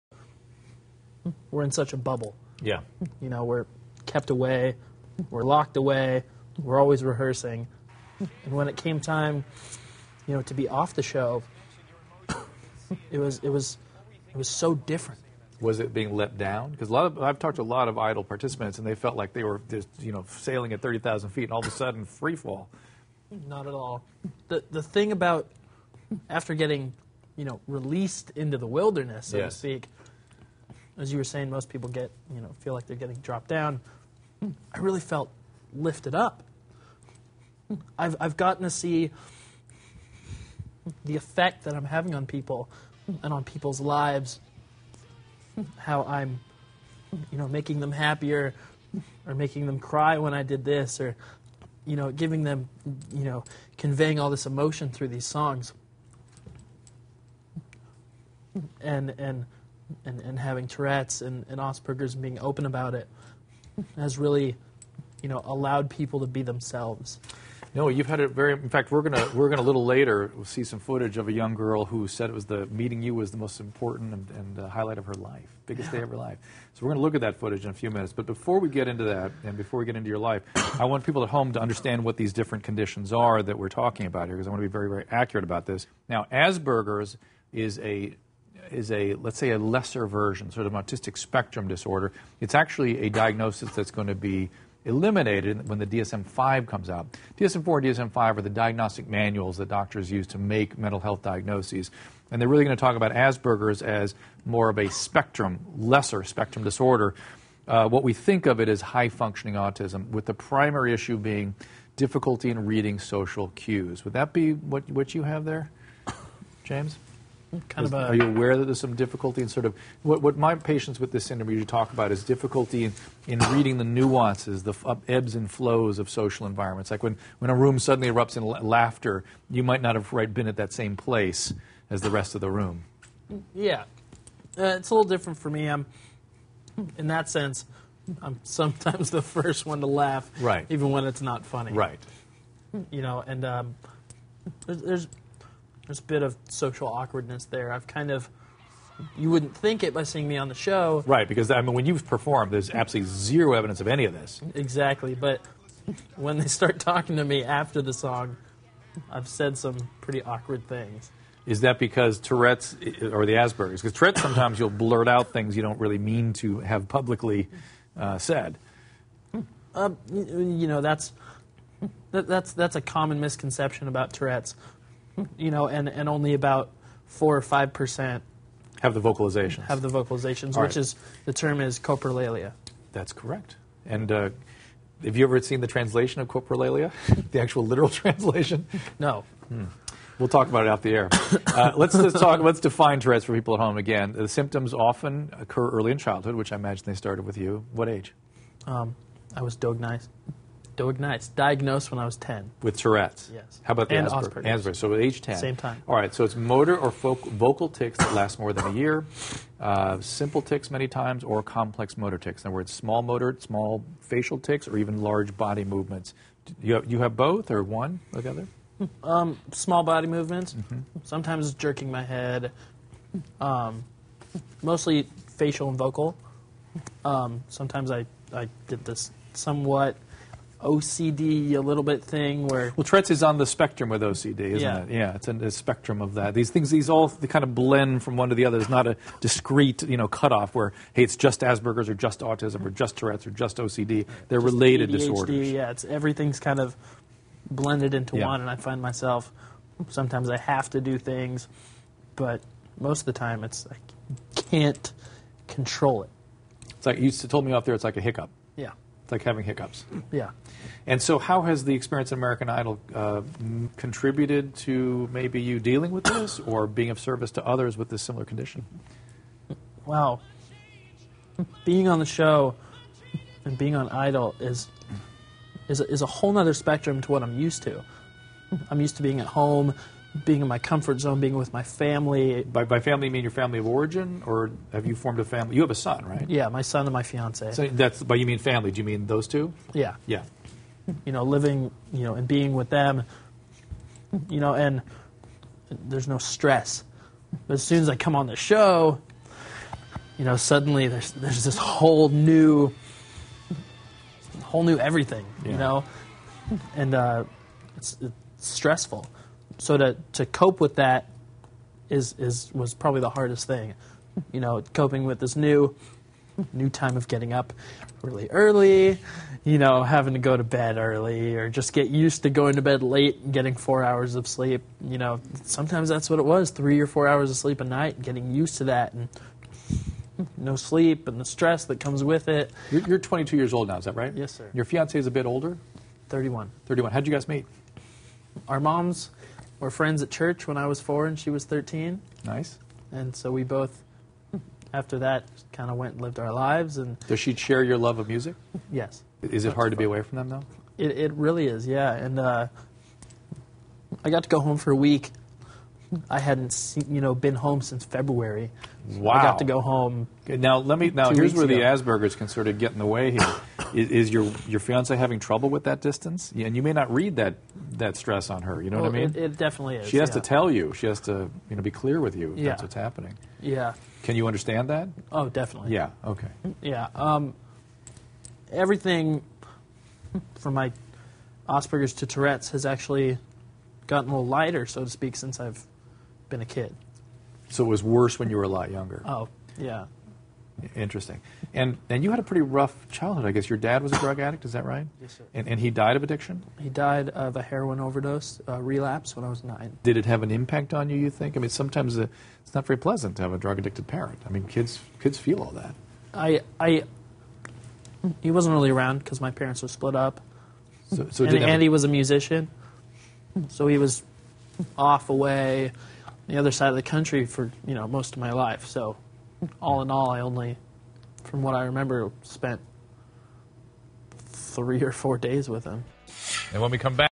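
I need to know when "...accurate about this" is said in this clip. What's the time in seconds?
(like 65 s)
85 s.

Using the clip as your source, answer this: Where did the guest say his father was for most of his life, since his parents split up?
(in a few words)
The other side of the country.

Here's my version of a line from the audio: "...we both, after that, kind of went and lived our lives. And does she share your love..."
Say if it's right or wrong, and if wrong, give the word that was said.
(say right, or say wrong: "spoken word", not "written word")
right.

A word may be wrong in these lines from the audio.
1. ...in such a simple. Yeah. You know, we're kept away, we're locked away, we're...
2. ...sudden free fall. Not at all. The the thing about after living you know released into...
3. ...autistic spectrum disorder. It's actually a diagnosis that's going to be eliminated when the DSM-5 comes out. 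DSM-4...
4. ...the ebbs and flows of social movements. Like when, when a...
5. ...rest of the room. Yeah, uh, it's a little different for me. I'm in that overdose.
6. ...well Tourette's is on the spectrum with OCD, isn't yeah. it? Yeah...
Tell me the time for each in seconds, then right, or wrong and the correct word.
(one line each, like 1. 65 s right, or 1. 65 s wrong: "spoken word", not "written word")
1. 1 s wrong: "bubble", not "simple"
2. 21 s wrong: "getting", not "living"
3. 90 s right
4. 124 s wrong: "environments", not "movements"
5. 132 s wrong: "sense", not "overdose"
6. 232 s right.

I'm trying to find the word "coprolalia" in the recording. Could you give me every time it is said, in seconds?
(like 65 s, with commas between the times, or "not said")
181 s, 186 s.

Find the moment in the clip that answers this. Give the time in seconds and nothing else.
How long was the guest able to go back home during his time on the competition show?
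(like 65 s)
354 s.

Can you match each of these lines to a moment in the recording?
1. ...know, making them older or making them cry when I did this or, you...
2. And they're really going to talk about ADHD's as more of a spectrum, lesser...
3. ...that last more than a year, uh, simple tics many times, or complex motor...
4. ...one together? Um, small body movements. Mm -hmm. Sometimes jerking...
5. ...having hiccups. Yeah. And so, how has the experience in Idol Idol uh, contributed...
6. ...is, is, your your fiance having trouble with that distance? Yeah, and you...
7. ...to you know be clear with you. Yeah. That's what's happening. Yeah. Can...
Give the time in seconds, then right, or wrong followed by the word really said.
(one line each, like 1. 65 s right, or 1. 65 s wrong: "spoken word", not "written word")
1. 47 s wrong: "happier", not "older"
2. 102 s wrong: "Asperger", not "ADHD"
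3. 207 s right
4. 217 s right
5. 259 s wrong: "American", not "Idol"
6. 363 s right
7. 371 s right.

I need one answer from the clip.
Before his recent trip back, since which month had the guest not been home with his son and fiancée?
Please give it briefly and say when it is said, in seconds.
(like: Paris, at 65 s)
February, at 357 s.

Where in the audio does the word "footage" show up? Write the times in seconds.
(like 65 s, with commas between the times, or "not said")
70 s, 77 s.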